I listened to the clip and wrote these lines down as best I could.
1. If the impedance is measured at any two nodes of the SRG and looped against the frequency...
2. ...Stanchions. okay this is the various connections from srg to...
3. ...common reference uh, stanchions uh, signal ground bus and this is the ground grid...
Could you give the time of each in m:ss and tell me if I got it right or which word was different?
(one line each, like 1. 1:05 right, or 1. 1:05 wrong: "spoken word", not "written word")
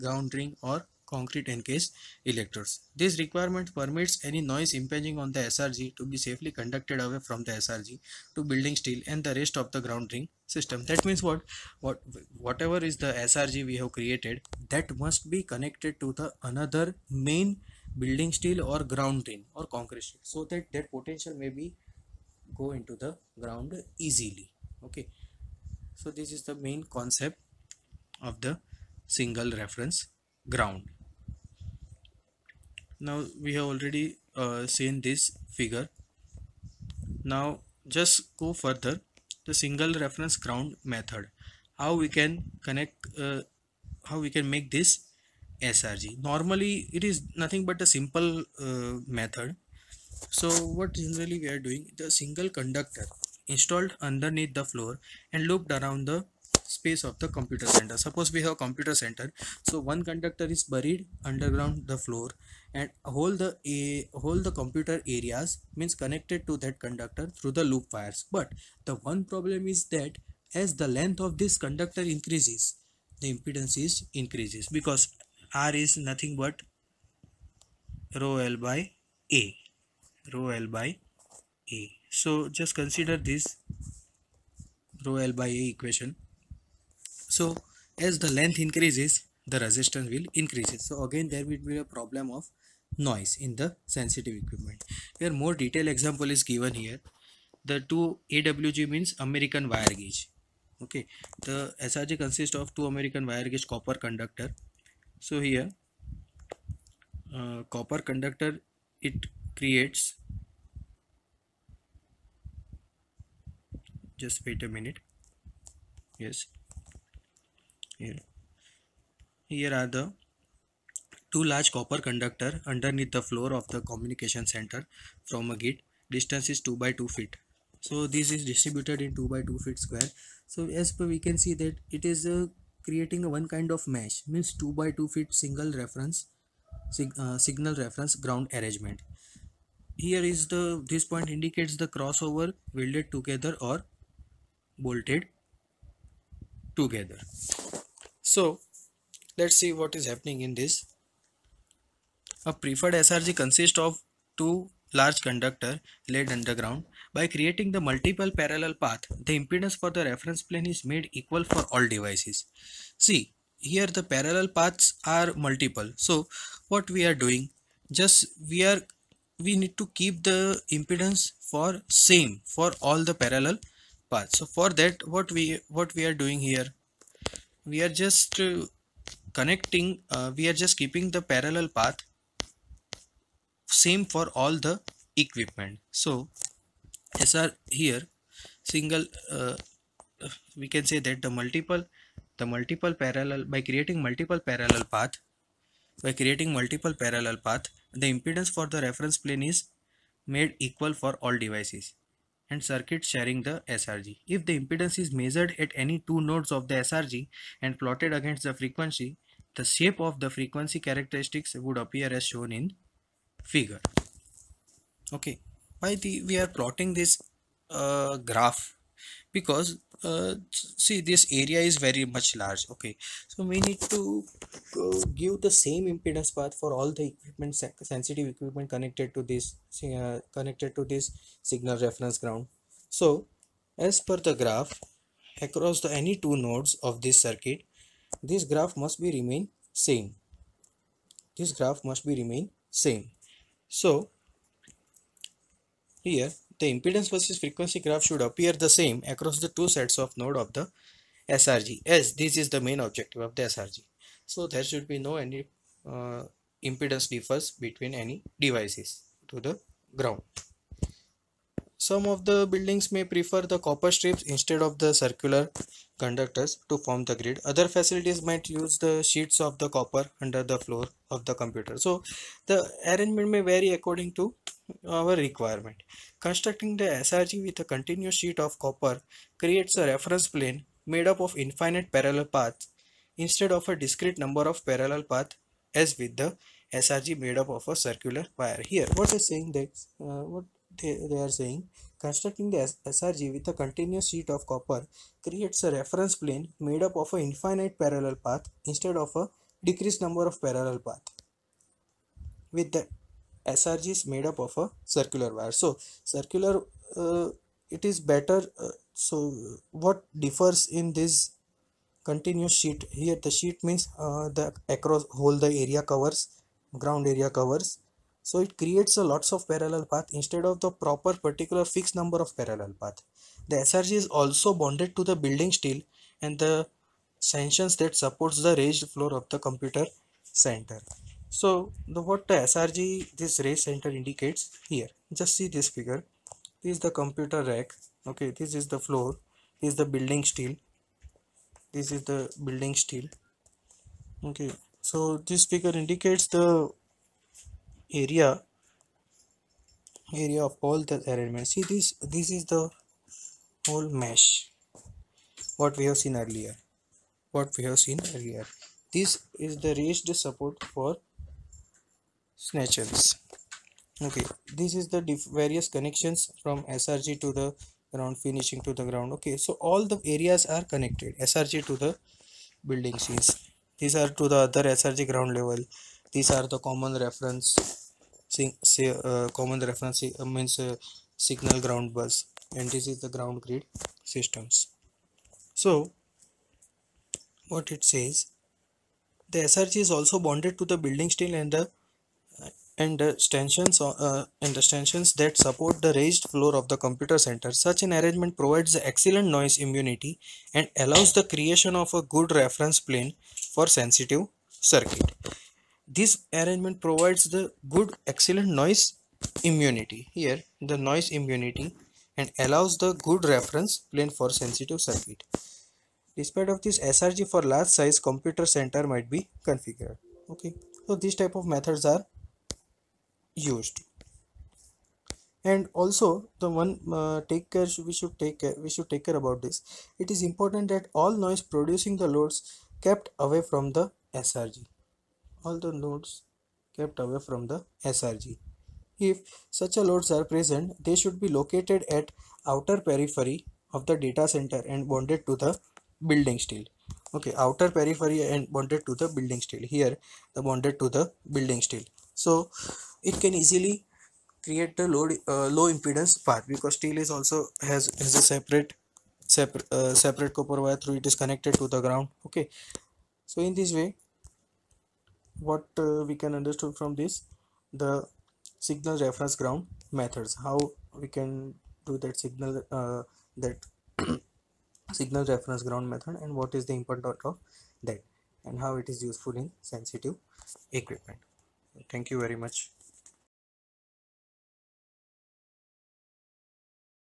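1. 3:24 wrong: "plotted", not "looped"
2. 6:02 right
3. 6:19 wrong: "means", not "stanchions".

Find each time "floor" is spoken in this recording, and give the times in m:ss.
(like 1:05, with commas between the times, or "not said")
0:54, 1:01, 2:03, 4:30, 5:28, 5:38, 6:36.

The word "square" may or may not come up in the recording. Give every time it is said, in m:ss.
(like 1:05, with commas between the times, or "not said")
2:09.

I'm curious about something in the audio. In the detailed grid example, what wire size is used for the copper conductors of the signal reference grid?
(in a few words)
2 AWG.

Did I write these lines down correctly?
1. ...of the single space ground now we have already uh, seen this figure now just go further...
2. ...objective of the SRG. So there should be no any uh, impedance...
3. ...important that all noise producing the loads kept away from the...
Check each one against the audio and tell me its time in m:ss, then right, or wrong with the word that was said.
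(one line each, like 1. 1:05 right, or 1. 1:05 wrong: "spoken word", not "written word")
1. 0:28 wrong: "reference", not "space"
2. 4:12 right
3. 7:10 right.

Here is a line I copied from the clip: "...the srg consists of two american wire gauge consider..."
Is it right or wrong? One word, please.
wrong.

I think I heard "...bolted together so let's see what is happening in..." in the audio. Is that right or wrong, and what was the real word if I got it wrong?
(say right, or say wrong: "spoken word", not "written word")
right.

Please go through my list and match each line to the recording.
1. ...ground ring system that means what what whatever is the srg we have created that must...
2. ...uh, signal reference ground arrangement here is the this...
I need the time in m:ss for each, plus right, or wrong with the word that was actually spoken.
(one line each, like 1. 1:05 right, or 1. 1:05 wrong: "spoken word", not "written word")
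1. 0:09 right
2. 2:17 right.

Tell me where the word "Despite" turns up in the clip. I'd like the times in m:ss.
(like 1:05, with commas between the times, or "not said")
6:56.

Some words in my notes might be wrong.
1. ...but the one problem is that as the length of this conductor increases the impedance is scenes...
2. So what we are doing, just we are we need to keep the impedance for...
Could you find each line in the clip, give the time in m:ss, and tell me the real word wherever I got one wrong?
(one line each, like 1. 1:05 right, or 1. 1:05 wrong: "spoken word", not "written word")
1. 1:08 wrong: "increases", not "scenes"
2. 2:45 right.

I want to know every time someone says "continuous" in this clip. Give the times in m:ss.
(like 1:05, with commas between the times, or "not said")
4:37, 4:53, 5:12.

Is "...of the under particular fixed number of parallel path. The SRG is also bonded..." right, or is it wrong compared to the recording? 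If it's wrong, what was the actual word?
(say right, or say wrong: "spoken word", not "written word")
wrong: "proper", not "under".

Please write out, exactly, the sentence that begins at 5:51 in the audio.
See this this is the whole mesh what we have seen earlier.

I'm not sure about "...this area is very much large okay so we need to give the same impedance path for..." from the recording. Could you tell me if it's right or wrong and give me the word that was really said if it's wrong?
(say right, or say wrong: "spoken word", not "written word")
right.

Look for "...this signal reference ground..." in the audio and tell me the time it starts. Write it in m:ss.
3:50.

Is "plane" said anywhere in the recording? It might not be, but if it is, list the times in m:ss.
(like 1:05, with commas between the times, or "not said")
2:40, 3:19, 4:40, 4:56, 6:42, 6:53.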